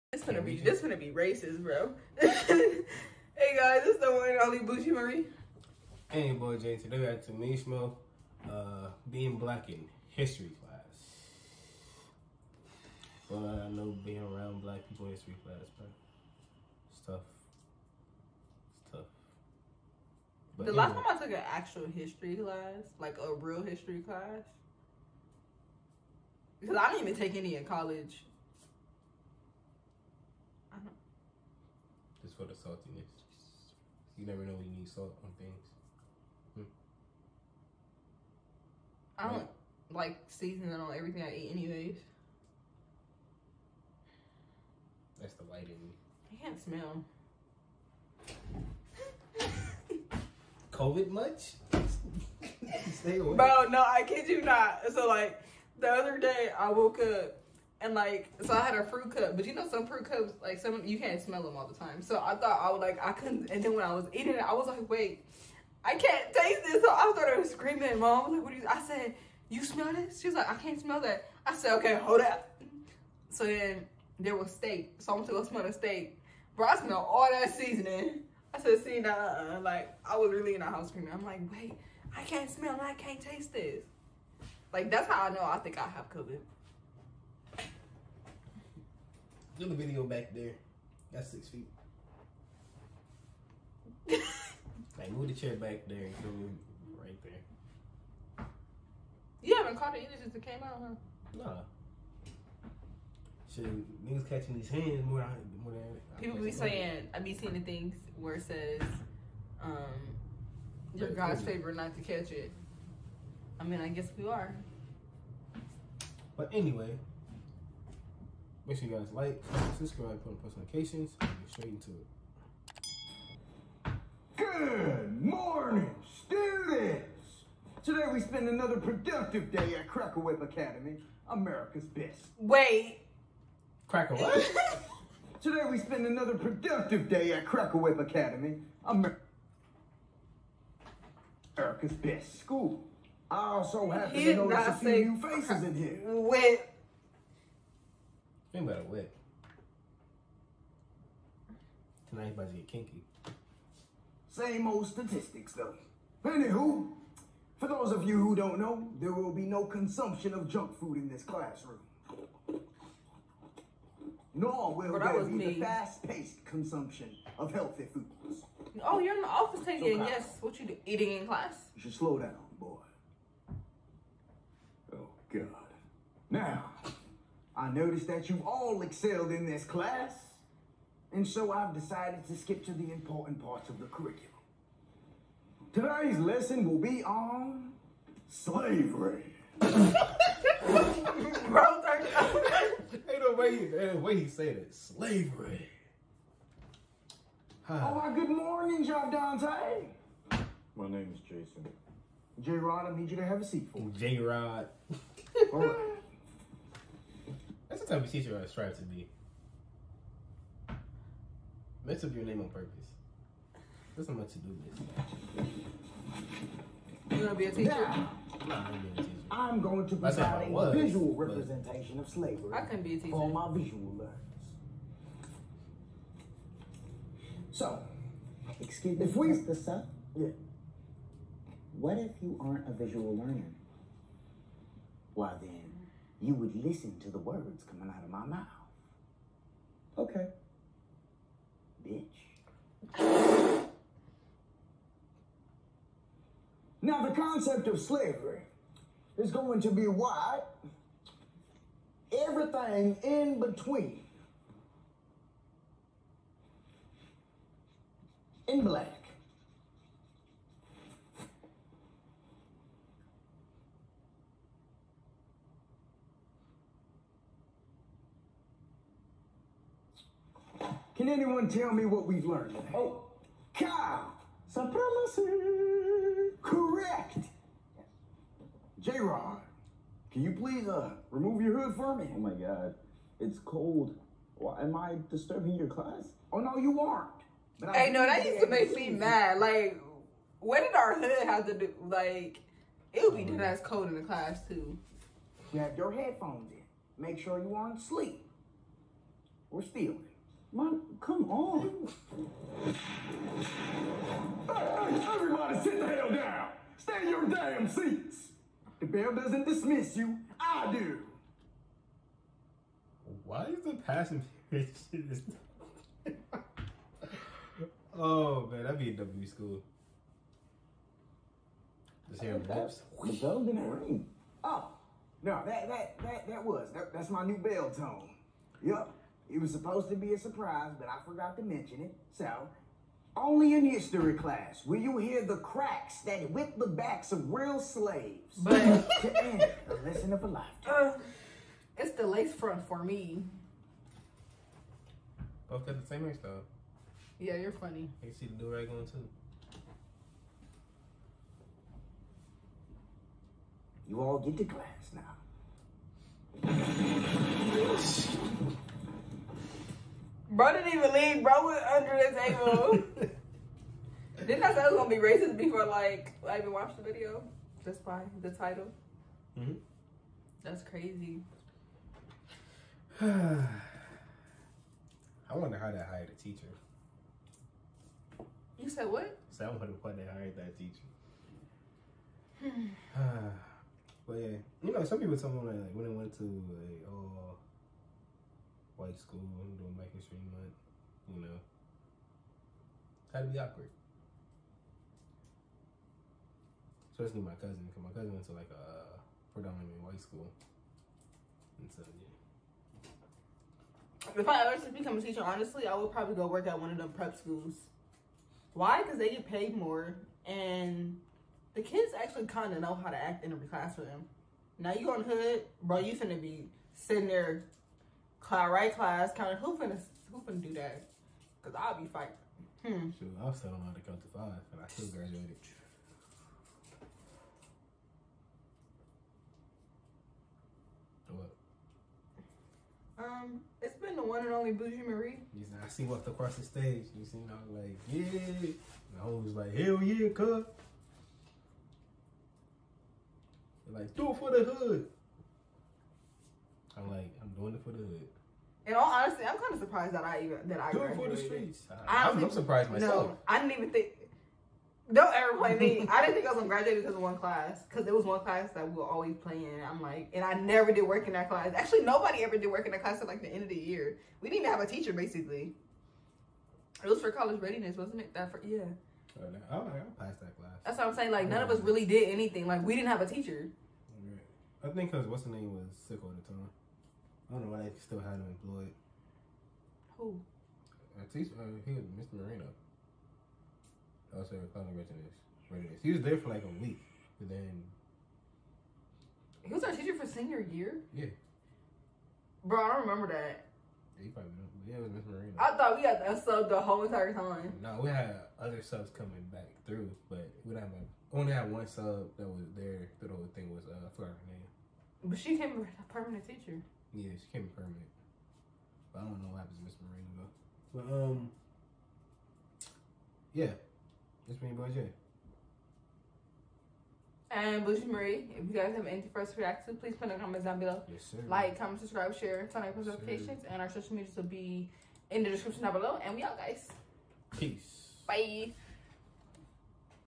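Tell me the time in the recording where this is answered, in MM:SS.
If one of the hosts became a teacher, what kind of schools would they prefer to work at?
06:46.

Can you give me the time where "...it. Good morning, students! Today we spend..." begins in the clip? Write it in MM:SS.
02:03.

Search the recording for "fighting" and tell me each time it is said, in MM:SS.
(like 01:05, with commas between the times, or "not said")
07:01.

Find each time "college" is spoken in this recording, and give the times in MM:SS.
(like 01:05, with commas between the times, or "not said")
00:27, 07:47.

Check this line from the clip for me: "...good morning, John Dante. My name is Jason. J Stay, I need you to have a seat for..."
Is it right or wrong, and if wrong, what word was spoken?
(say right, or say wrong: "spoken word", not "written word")
wrong: "Rod", not "Stay".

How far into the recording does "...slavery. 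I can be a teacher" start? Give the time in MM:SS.
03:42.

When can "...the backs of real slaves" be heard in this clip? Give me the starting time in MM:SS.
05:36.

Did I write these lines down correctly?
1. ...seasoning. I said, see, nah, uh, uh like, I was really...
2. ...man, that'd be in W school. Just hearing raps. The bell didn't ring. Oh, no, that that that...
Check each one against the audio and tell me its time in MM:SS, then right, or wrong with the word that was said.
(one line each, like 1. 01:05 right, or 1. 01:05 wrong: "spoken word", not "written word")
1. 01:17 right
2. 05:18 right.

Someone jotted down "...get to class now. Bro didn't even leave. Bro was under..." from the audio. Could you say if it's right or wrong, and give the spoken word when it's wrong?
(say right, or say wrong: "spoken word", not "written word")
right.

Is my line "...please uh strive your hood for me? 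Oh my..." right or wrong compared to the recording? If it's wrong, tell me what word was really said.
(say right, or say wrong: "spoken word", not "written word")
wrong: "remove", not "strive".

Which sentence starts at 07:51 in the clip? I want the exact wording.
Like none of us really did anything.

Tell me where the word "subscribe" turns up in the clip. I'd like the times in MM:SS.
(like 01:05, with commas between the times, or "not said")
01:59, 08:41.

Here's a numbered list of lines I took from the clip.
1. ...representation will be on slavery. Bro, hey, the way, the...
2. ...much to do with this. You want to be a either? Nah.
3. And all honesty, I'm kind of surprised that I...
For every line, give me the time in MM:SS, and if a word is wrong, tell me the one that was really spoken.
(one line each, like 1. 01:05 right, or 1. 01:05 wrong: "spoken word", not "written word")
1. 03:06 wrong: "lesson", not "representation"
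2. 03:34 wrong: "teacher", not "either"
3. 07:28 right.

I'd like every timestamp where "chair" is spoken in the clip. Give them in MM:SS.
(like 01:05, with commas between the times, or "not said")
01:35.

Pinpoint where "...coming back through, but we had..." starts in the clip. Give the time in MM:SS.
08:18.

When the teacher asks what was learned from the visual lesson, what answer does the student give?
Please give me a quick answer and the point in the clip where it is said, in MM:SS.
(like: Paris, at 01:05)
Cow supremacy, at 04:33.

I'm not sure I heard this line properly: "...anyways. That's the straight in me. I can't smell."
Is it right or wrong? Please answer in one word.
wrong.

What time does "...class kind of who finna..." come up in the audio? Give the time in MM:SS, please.
06:58.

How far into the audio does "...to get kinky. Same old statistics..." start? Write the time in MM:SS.
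02:32.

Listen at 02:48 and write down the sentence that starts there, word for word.
Oh, you're in the office taking so yes.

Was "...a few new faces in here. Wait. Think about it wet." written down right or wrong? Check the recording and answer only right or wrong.
right.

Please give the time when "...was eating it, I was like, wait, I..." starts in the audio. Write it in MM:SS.
01:03.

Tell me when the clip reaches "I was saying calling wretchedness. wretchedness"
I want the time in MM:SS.
08:04.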